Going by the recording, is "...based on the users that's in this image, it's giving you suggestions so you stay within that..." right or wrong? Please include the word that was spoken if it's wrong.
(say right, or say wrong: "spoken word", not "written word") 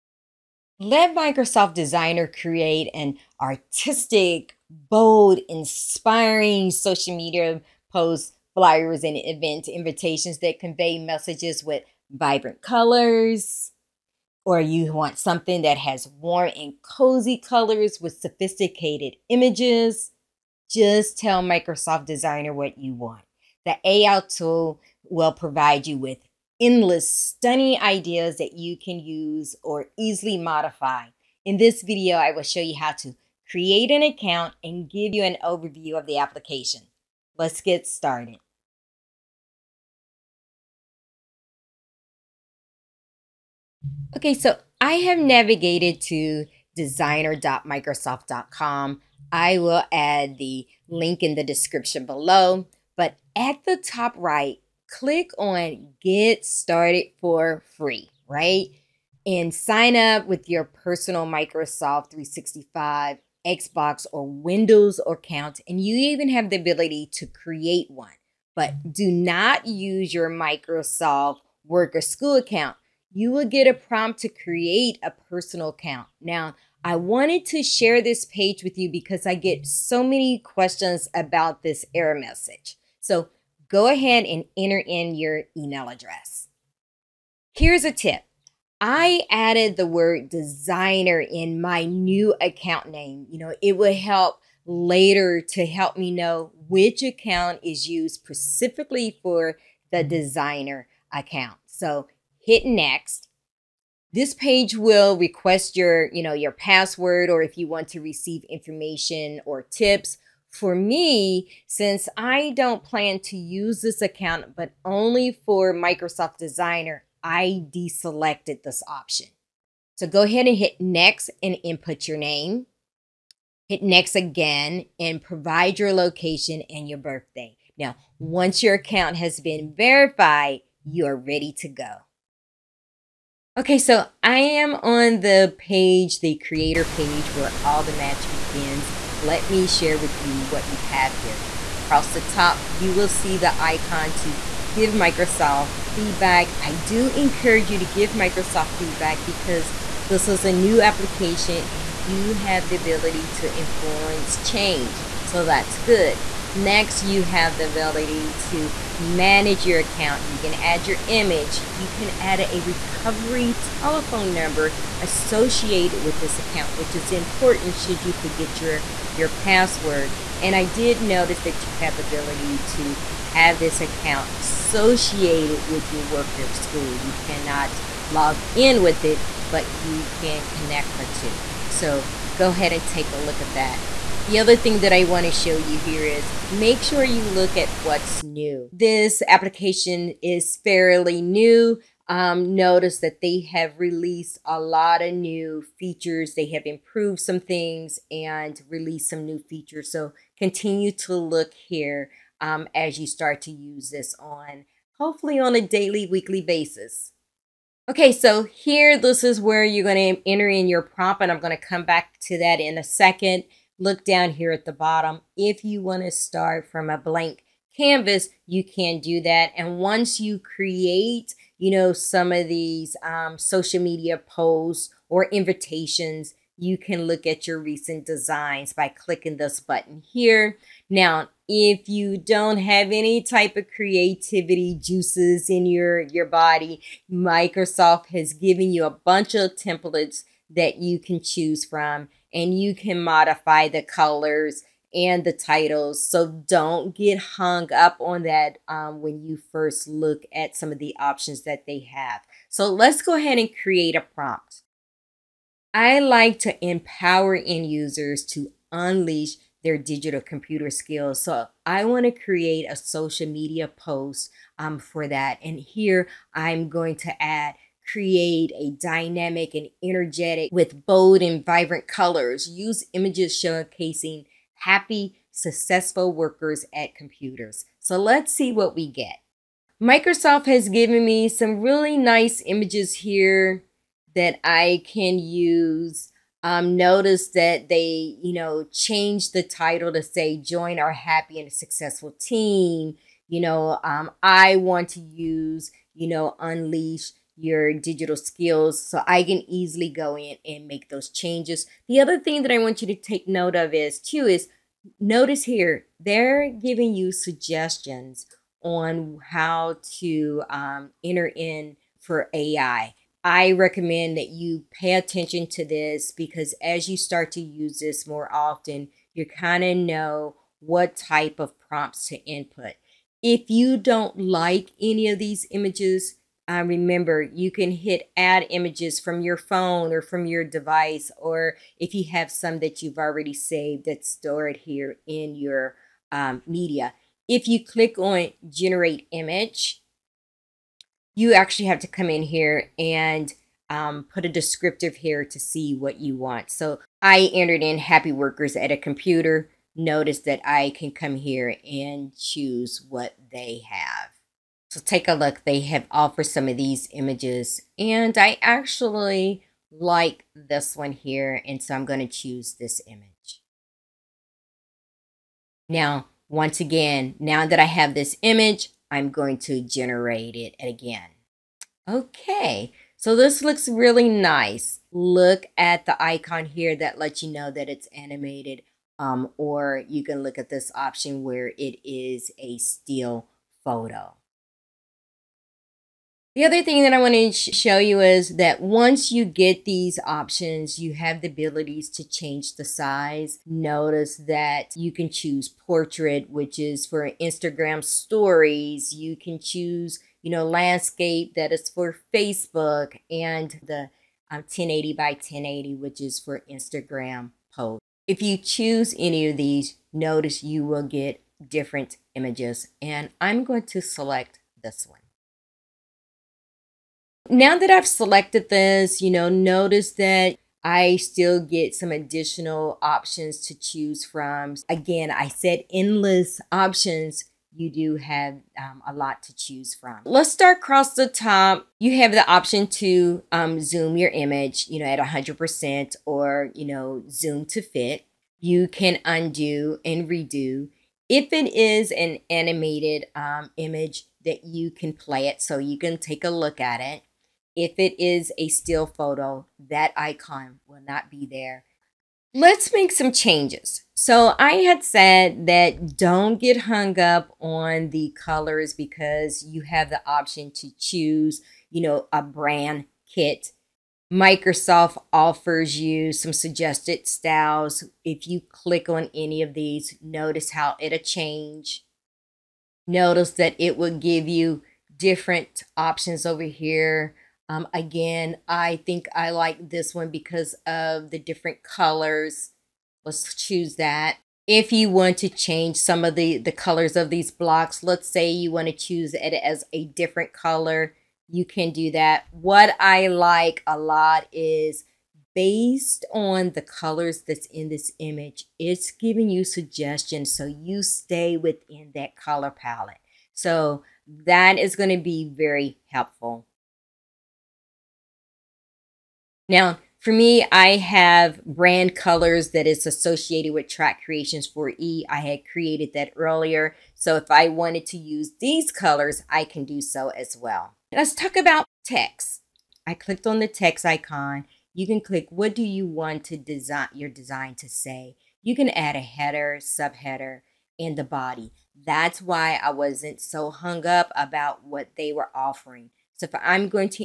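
wrong: "colors", not "users".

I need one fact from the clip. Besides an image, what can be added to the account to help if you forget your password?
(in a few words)
recovery telephone number.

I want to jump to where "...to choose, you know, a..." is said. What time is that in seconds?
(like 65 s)
460 s.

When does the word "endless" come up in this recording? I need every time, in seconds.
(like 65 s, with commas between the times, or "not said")
26 s, 425 s.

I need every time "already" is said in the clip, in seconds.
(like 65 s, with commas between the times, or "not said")
332 s.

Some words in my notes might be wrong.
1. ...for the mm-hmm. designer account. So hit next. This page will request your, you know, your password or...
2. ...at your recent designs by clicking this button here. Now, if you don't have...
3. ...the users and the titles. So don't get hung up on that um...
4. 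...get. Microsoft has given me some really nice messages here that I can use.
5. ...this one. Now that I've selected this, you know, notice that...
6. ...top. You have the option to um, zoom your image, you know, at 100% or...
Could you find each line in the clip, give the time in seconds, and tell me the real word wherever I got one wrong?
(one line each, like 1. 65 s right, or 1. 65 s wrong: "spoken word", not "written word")
1. 99 s right
2. 227 s right
3. 243 s wrong: "colors", not "users"
4. 278 s wrong: "images", not "messages"
5. 414 s right
6. 431 s right.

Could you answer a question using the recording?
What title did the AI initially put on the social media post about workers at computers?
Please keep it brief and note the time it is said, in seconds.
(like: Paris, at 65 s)
join our happy and successful team, at 290 s.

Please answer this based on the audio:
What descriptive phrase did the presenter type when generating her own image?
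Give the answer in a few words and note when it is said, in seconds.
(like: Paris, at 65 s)
happy workers at a computer, at 347 s.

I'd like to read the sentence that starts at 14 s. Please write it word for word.
Or you want something that has warm and cozy colors with sophisticated images.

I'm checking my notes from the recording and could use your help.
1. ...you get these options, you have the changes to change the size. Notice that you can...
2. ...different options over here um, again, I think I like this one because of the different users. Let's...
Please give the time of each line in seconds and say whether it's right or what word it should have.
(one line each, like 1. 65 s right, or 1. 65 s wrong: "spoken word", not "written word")
1. 389 s wrong: "abilities", not "changes"
2. 474 s wrong: "colors", not "users".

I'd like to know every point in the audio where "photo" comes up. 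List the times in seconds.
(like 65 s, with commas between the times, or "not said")
383 s, 448 s.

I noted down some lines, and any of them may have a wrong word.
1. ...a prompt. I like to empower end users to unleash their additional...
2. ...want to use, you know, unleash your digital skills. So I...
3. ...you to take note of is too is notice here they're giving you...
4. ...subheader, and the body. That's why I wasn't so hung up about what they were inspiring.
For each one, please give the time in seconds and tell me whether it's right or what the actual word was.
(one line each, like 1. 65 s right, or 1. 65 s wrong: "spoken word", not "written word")
1. 253 s wrong: "digital", not "additional"
2. 294 s right
3. 302 s right
4. 529 s wrong: "offering", not "inspiring".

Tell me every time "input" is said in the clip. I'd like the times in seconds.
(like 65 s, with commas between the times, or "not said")
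121 s, 322 s.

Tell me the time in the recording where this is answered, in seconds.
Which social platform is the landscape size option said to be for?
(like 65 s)
402 s.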